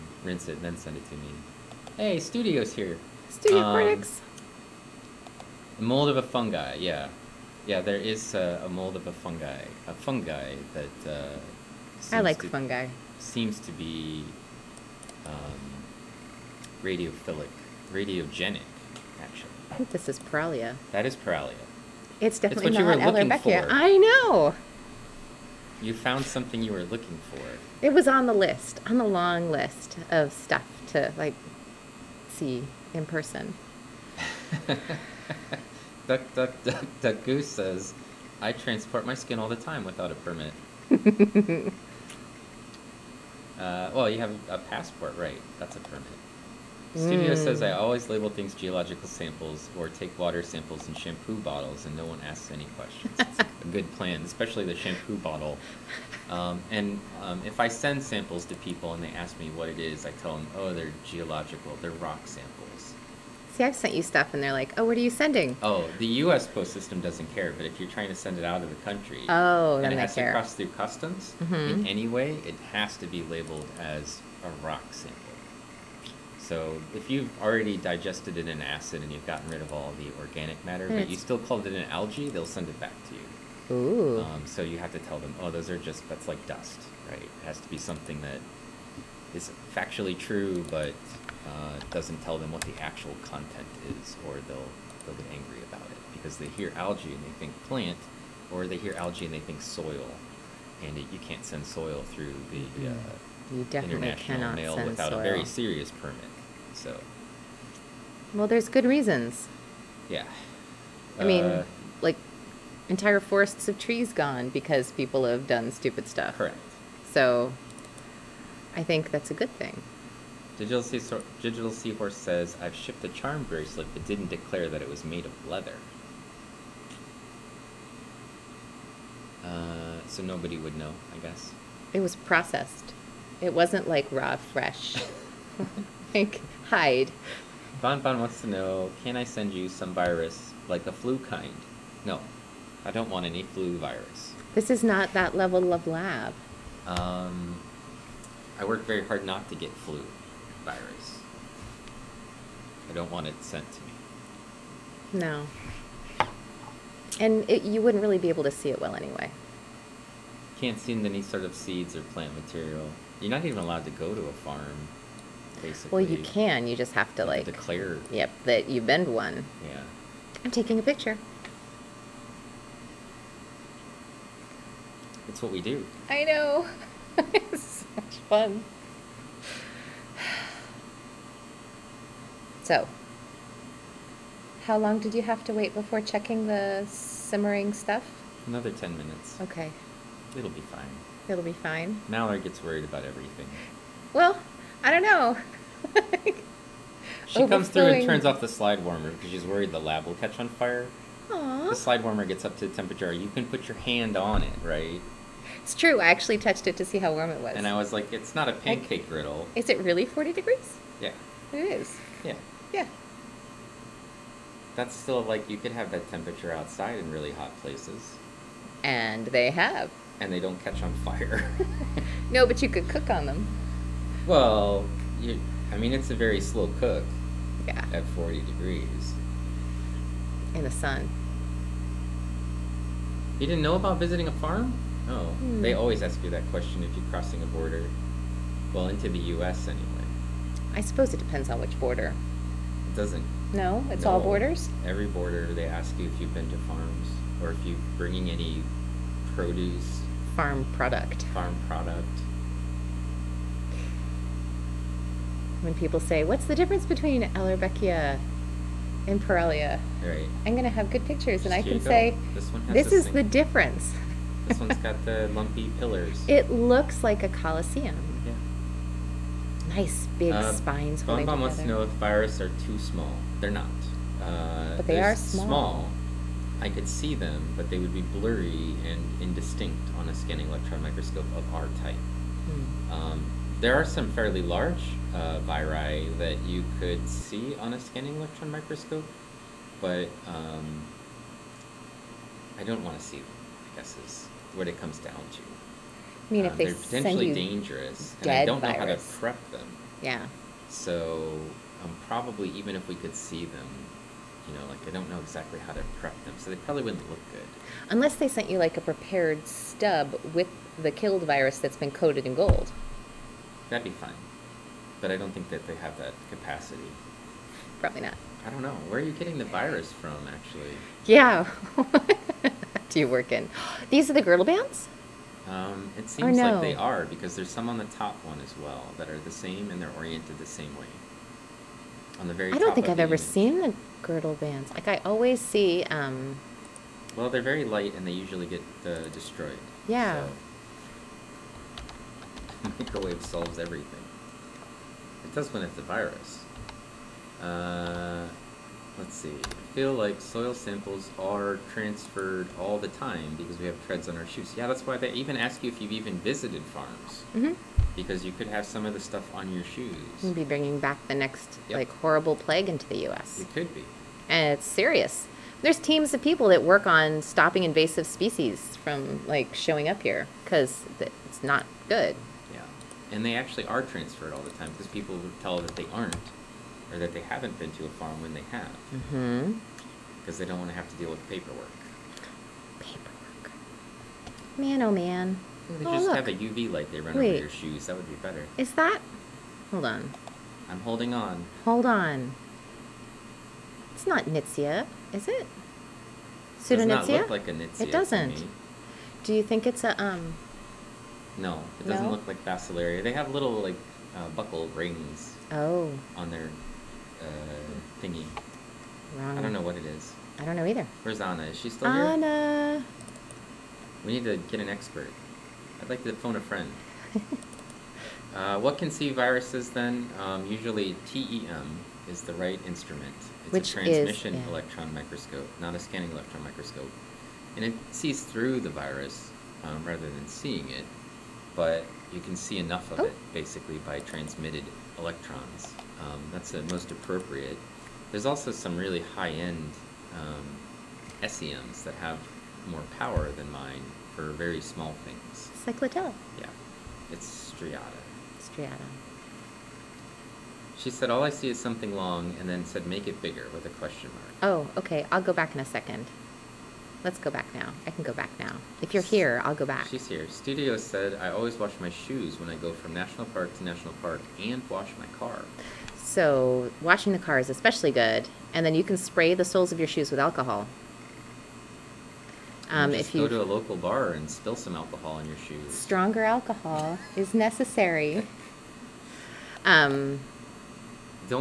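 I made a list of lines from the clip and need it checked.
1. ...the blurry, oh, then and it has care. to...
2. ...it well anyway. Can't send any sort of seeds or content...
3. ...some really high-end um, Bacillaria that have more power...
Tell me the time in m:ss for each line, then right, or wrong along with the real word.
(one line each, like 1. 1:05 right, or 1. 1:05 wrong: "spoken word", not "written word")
1. 1:08 wrong: "country", not "blurry"
2. 2:38 wrong: "plant", not "content"
3. 7:18 wrong: "SEMs", not "Bacillaria".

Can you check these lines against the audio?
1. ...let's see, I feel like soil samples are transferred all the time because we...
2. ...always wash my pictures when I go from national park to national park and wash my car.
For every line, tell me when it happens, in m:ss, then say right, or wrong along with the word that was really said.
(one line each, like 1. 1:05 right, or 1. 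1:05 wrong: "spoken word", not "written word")
1. 5:48 right
2. 7:41 wrong: "shoes", not "pictures".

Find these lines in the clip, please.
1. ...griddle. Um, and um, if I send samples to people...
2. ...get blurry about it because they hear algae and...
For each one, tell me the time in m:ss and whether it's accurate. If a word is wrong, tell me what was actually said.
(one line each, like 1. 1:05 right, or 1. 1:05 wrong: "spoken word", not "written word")
1. 0:55 wrong: "bottle", not "griddle"
2. 1:35 wrong: "angry", not "blurry".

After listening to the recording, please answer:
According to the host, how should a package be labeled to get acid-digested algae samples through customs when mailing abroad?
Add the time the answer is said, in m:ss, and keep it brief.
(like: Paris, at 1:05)
rock sample, at 1:14.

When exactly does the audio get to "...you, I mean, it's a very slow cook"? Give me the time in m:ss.
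3:45.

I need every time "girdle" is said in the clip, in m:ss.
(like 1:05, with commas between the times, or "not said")
5:24, 5:34.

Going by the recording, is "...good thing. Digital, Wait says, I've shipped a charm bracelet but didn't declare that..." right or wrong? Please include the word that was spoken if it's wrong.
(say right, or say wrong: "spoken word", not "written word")
wrong: "Seahorse", not "Wait".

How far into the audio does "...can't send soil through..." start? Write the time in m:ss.
1:41.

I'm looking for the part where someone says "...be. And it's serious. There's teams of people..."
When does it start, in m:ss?
6:03.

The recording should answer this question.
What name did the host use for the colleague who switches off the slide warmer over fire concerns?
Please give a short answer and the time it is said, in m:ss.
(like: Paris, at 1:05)
Mallory, at 3:12.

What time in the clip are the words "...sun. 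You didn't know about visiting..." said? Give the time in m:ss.
3:50.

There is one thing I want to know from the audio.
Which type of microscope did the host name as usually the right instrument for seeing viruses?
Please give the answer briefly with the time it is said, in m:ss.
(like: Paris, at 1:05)
TEM, at 7:01.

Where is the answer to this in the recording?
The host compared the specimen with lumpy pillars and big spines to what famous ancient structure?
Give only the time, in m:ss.
4:27.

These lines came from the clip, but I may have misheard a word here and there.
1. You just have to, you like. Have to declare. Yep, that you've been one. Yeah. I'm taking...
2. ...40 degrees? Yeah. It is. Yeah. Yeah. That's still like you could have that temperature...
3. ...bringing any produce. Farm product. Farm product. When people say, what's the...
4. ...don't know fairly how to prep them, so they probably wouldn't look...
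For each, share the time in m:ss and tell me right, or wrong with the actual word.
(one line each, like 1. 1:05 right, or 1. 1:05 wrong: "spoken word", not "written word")
1. 2:46 right
2. 3:30 right
3. 4:07 right
4. 5:04 wrong: "exactly", not "fairly".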